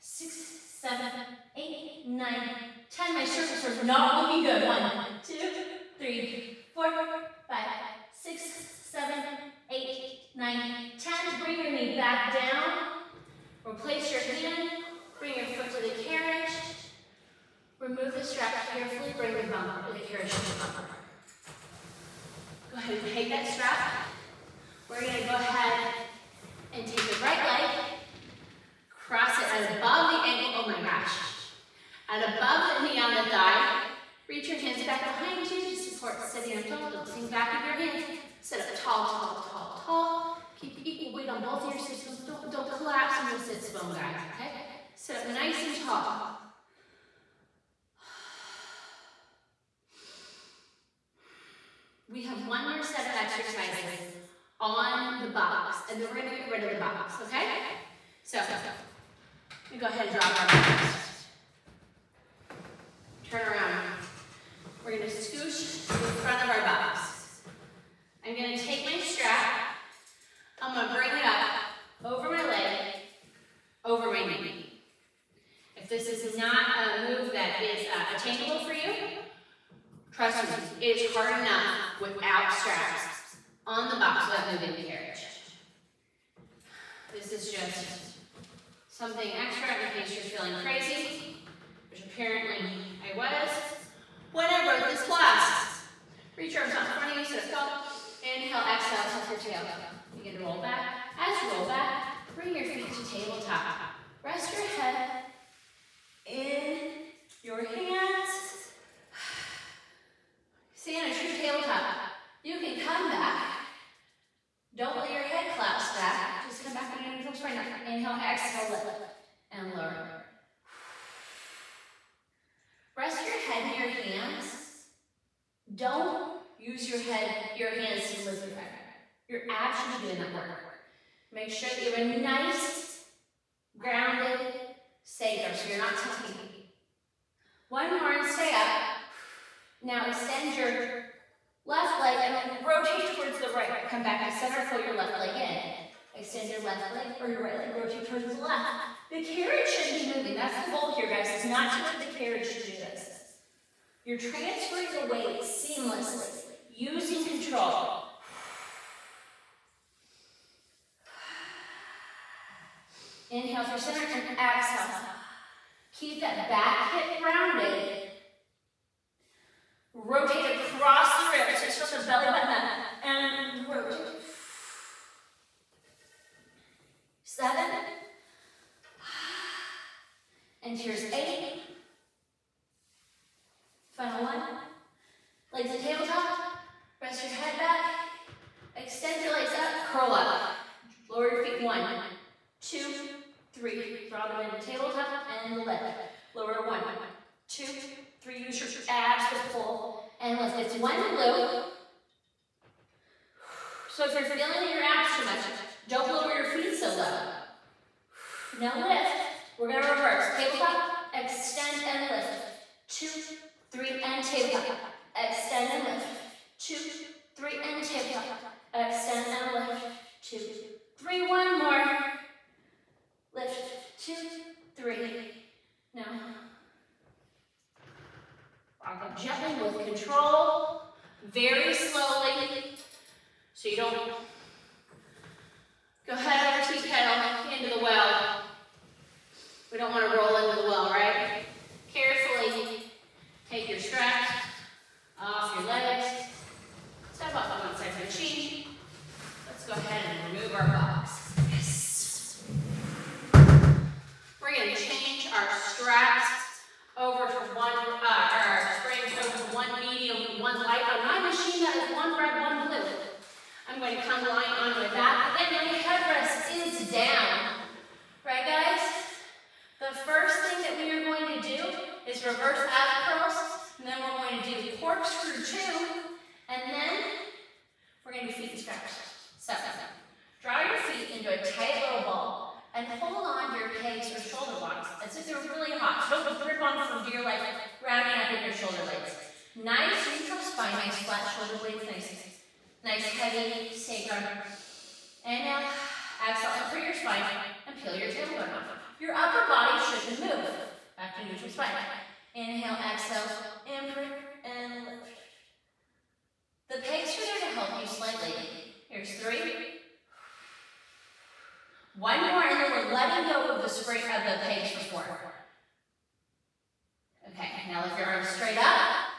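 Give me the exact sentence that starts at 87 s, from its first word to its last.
This is just something extra in case you're feeling crazy, which apparently I was when I wrote this class.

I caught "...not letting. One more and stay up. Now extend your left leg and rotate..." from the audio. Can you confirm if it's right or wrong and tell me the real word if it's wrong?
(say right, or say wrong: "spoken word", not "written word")
wrong: "tucking", not "letting".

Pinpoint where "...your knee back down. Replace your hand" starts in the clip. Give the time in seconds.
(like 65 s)
11 s.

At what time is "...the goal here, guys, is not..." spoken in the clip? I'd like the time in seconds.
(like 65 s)
150 s.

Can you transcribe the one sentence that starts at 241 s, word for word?
Carefully take your straps off your legs.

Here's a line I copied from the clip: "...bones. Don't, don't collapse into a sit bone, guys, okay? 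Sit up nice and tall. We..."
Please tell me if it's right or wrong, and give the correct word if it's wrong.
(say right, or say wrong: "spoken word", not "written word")
right.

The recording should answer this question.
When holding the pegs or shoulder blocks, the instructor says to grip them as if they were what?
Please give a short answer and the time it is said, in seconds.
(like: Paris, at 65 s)
Really hot, at 285 s.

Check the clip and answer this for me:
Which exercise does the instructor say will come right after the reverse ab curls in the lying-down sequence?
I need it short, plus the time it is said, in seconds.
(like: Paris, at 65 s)
Corkscrew two, at 274 s.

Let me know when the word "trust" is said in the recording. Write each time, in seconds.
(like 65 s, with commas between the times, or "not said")
80 s.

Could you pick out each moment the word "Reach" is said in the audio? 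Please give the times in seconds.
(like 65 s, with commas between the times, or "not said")
34 s, 96 s.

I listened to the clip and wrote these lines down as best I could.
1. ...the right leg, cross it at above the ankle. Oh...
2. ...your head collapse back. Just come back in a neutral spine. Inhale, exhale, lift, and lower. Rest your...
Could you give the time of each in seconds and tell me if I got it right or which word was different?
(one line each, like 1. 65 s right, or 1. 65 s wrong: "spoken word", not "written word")
1. 27 s right
2. 115 s right.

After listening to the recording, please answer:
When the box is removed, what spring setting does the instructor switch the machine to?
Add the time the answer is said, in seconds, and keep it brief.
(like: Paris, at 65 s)
One medium, one light, at 259 s.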